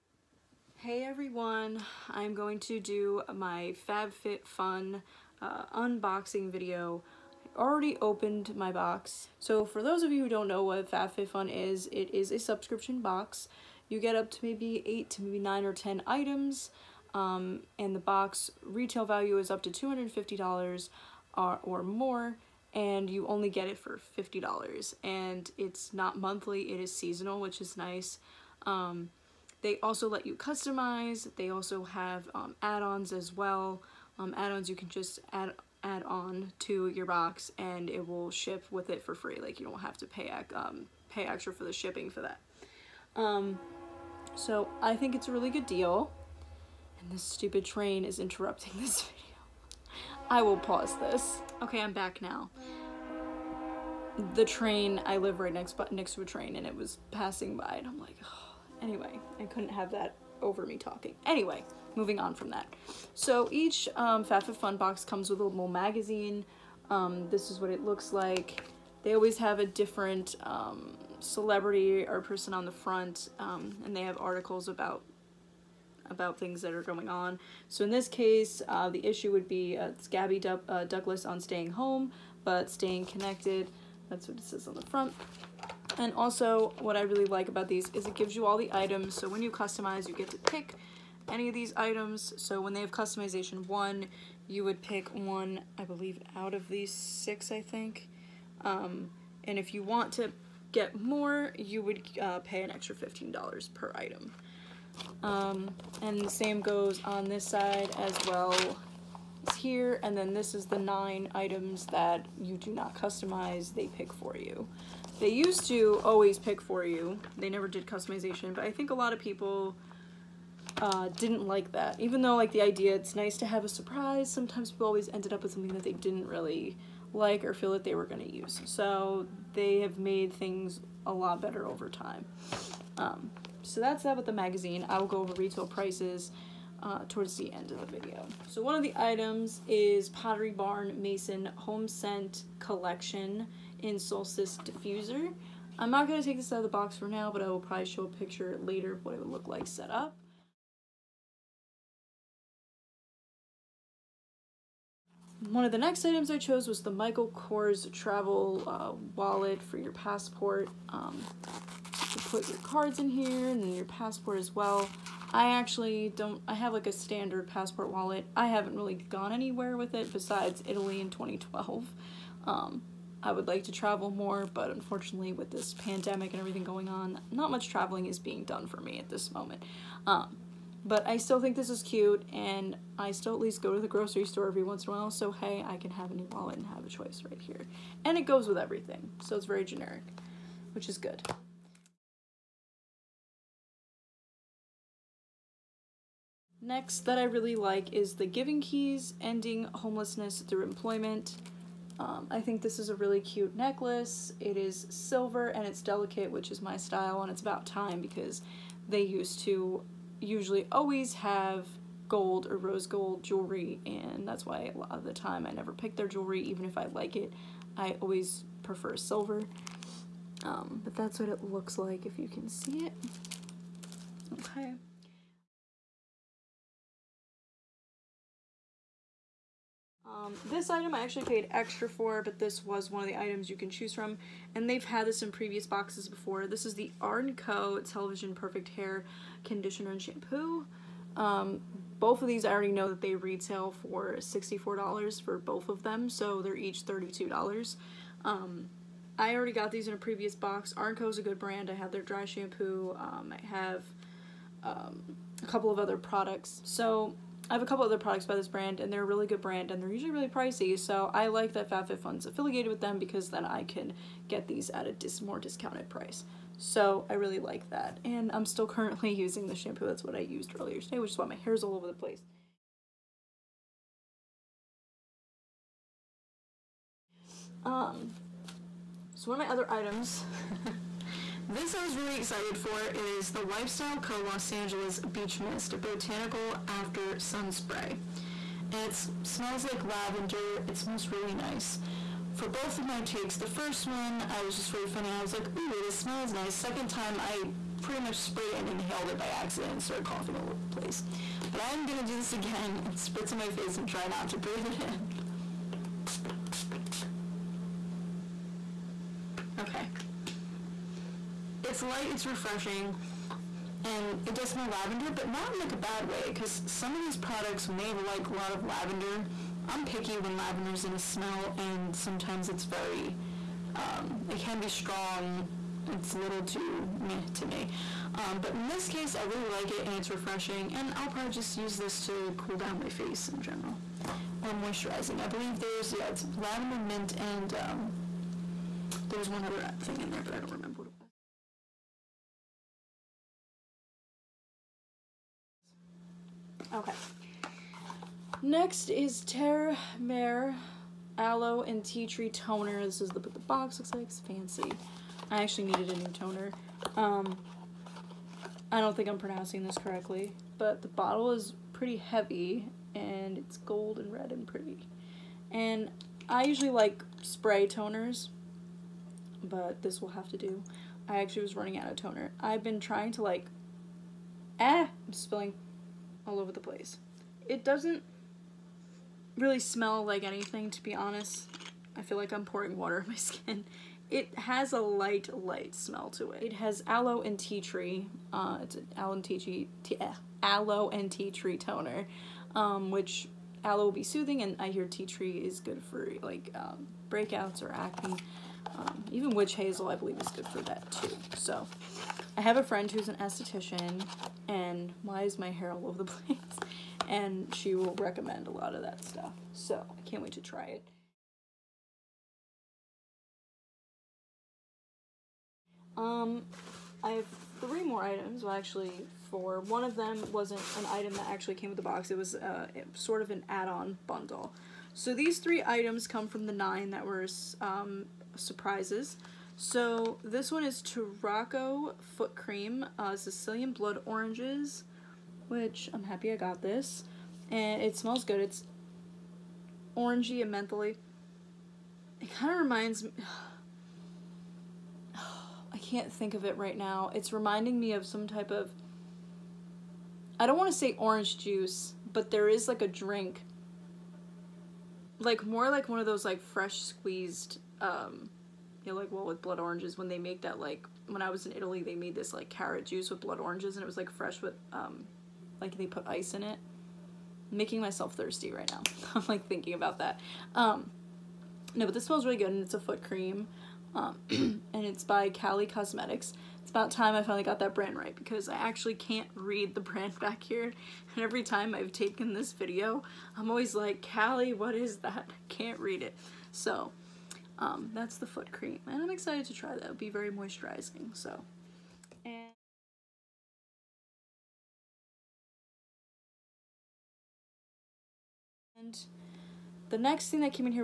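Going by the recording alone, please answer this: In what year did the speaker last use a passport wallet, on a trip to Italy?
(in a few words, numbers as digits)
2012.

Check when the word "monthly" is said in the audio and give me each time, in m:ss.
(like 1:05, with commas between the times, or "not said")
0:26.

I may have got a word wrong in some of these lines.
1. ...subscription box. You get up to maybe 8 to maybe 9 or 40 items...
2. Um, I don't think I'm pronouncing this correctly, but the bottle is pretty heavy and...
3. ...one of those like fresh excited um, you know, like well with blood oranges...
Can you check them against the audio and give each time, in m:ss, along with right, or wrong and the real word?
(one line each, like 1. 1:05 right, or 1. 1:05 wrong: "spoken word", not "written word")
1. 0:12 wrong: "10", not "40"
2. 5:56 right
3. 7:35 wrong: "squeezed", not "excited".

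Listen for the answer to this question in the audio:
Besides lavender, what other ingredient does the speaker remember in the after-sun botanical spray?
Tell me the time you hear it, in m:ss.
5:36.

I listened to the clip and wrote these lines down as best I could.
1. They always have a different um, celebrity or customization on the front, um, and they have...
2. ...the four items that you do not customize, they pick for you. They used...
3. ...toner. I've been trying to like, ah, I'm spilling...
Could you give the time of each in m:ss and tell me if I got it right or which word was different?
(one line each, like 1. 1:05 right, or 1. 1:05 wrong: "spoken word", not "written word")
1. 1:09 wrong: "person", not "customization"
2. 1:50 wrong: "nine", not "four"
3. 6:11 right.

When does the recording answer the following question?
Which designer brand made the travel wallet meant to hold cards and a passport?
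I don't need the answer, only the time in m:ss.
2:36.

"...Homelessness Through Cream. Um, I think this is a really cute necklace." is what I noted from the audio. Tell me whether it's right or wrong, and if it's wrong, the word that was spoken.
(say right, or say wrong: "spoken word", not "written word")
wrong: "Employment", not "Cream".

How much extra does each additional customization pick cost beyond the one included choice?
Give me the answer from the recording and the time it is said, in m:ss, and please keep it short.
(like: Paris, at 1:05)
$15, at 1:42.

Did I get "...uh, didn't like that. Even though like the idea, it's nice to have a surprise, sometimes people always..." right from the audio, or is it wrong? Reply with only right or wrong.
right.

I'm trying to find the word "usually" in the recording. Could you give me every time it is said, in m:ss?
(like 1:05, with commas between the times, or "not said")
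3:30, 4:19, 6:06.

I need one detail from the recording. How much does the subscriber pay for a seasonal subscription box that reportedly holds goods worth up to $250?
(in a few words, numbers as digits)
$50.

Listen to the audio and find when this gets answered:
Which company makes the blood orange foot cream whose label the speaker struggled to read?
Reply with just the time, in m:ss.
7:55.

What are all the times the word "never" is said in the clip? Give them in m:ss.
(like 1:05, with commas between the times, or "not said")
1:57, 3:35.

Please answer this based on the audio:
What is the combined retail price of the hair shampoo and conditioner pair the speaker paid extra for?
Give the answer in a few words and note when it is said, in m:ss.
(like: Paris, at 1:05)
$64, at 4:04.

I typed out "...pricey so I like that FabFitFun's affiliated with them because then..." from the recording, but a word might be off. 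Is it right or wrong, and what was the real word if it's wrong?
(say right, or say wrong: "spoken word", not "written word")
right.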